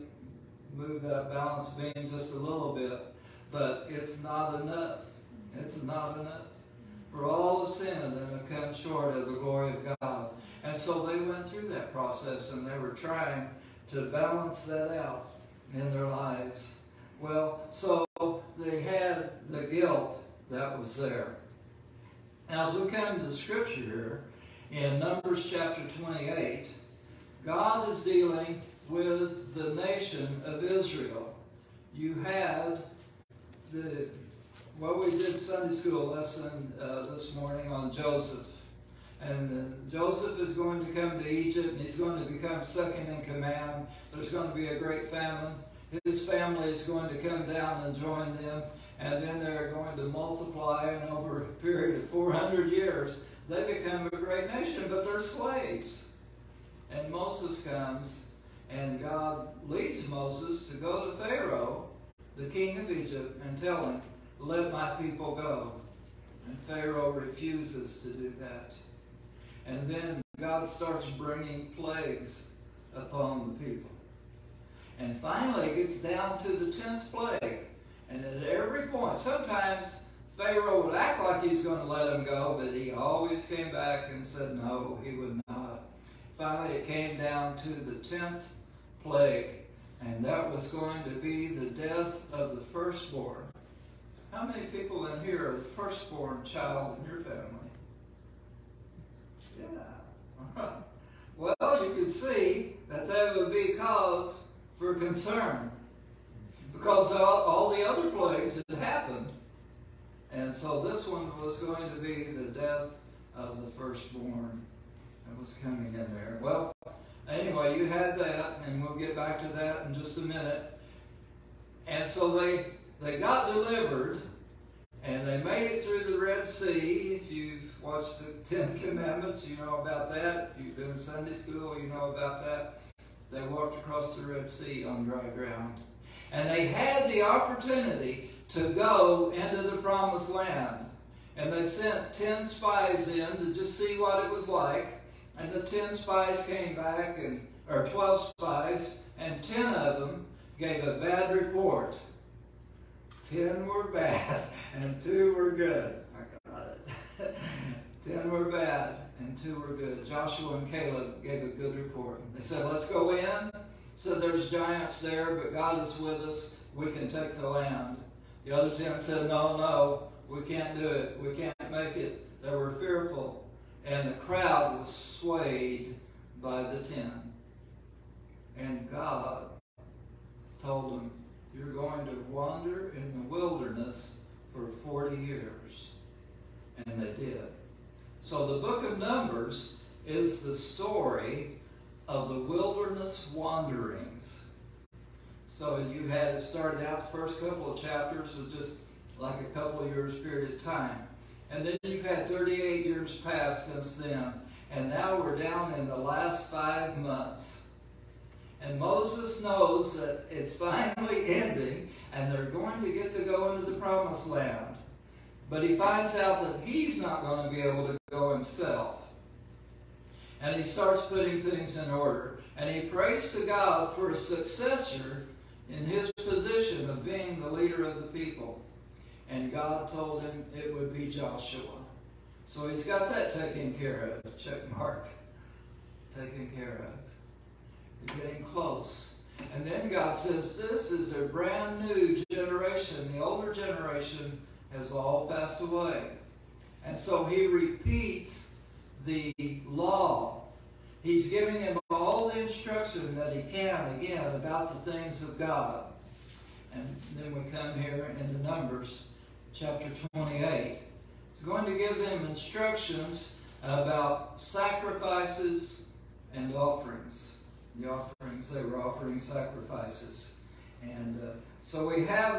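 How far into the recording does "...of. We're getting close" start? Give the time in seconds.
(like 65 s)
236 s.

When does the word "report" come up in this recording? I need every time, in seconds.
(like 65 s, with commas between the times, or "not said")
151 s, 161 s.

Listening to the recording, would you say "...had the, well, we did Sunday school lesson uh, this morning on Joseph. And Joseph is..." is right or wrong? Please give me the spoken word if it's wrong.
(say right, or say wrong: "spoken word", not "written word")
right.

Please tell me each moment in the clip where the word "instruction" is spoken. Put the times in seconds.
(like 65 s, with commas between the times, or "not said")
252 s, 262 s.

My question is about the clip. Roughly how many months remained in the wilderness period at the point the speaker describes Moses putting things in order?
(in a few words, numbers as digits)
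5.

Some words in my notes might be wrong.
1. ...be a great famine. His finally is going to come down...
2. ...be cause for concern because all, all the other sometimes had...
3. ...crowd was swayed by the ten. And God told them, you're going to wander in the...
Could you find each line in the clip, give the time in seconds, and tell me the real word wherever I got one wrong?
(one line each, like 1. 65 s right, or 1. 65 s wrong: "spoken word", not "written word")
1. 44 s wrong: "family", not "finally"
2. 103 s wrong: "plagues", not "sometimes"
3. 174 s right.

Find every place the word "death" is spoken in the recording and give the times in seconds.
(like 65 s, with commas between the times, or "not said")
91 s, 112 s.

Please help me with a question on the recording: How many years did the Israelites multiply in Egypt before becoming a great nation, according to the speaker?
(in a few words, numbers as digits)
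400.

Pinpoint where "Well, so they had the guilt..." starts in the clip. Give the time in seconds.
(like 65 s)
17 s.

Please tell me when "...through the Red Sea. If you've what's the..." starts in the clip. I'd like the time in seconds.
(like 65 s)
125 s.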